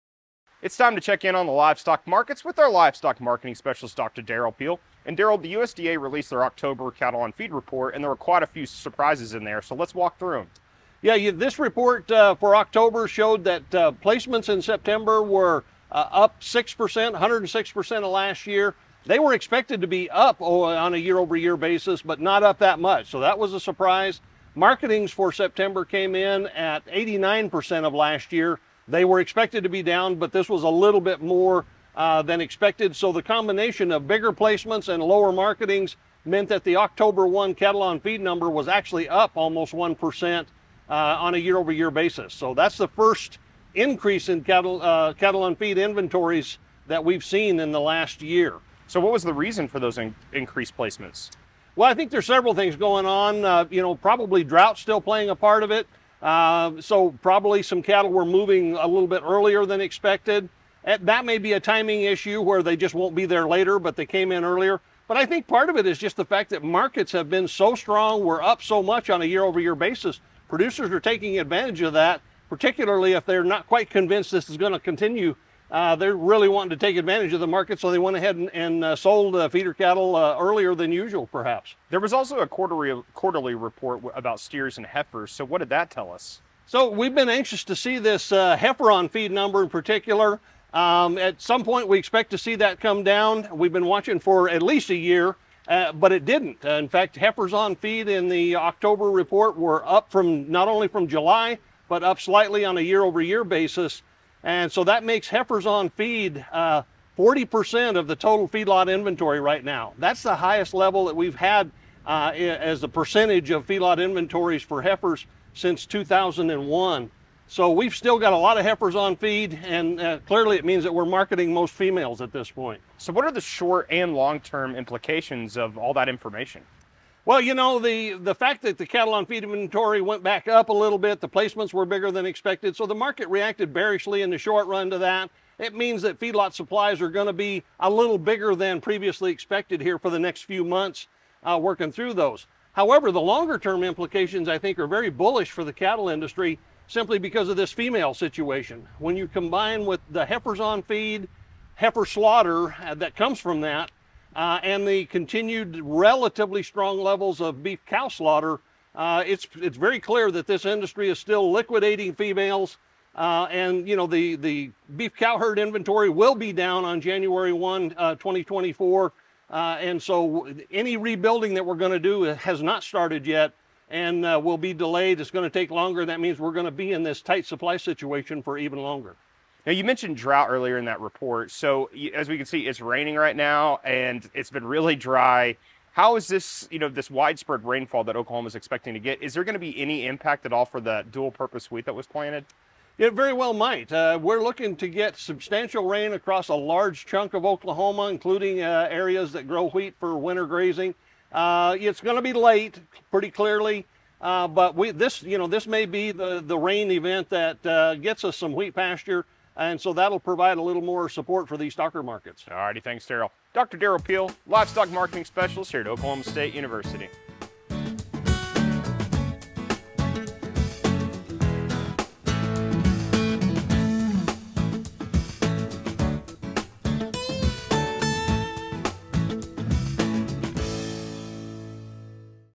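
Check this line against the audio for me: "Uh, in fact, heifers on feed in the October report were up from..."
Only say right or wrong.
right.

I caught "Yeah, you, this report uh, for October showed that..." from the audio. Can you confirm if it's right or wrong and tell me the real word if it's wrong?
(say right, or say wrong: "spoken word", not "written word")
right.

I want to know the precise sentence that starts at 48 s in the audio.
So, what was the reason for those in increased placements?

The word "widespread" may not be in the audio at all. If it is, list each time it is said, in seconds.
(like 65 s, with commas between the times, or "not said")
187 s.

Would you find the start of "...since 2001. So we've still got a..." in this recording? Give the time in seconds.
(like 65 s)
115 s.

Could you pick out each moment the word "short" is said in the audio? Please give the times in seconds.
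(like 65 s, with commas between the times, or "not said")
123 s, 134 s.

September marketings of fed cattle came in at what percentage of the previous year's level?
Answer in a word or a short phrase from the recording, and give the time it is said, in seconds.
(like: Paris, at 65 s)
89%, at 26 s.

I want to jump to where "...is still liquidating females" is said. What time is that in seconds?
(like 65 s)
161 s.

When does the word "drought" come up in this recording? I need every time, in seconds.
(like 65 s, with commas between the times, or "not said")
54 s, 180 s.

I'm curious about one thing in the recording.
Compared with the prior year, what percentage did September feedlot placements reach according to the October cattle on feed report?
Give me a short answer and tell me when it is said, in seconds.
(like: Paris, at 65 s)
106%, at 17 s.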